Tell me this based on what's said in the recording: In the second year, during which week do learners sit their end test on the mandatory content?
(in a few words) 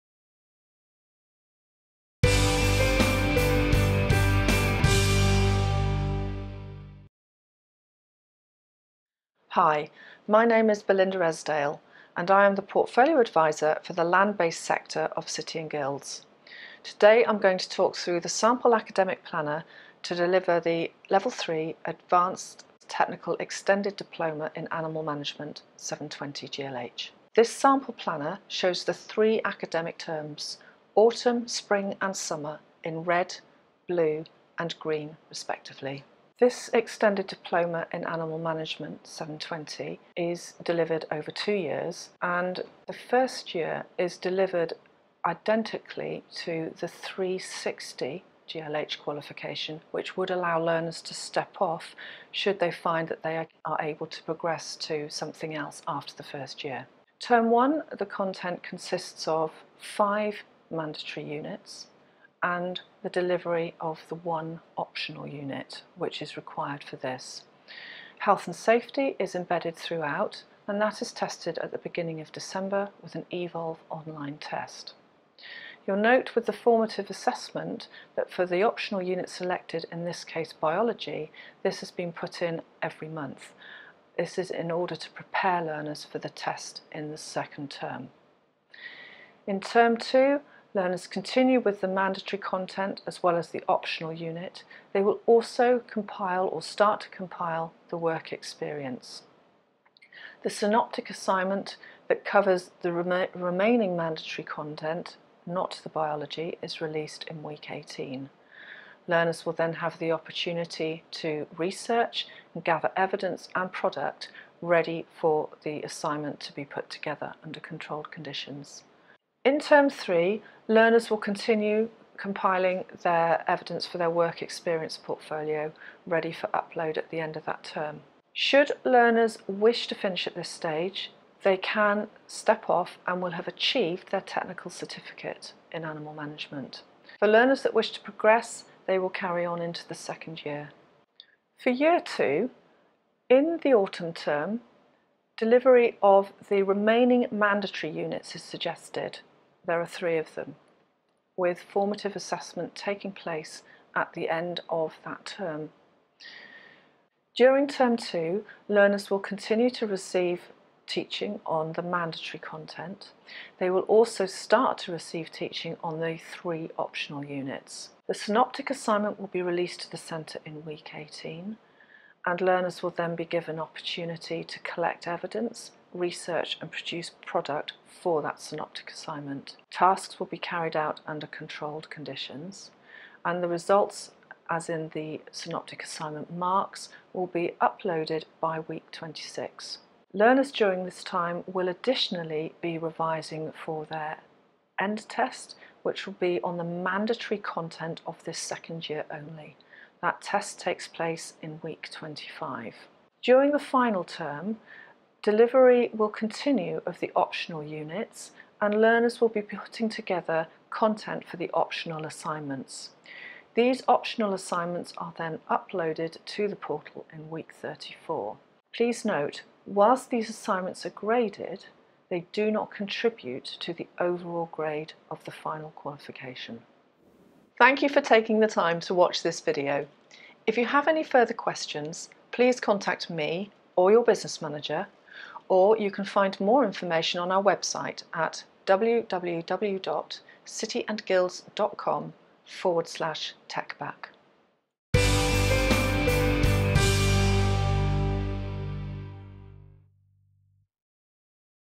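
Week 25.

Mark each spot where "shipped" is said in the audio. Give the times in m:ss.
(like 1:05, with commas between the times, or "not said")
not said.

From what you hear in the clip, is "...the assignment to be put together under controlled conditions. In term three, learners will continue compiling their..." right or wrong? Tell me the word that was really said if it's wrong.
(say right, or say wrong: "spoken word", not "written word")
right.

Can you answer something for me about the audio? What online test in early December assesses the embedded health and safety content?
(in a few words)
eVolve online test.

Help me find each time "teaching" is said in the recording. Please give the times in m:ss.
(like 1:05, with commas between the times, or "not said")
2:40, 2:45.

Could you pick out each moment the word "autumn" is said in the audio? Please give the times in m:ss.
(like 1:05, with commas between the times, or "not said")
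0:30, 2:23.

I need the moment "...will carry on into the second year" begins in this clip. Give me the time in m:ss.
2:18.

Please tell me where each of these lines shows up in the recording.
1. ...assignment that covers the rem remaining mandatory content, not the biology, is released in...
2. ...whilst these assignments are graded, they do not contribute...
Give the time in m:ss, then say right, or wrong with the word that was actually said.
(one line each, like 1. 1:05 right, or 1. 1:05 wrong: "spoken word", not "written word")
1. 1:41 right
2. 3:39 right.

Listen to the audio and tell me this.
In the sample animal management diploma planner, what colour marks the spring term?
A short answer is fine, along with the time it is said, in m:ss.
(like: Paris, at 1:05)
Blue, at 0:33.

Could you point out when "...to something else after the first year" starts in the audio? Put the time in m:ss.
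0:54.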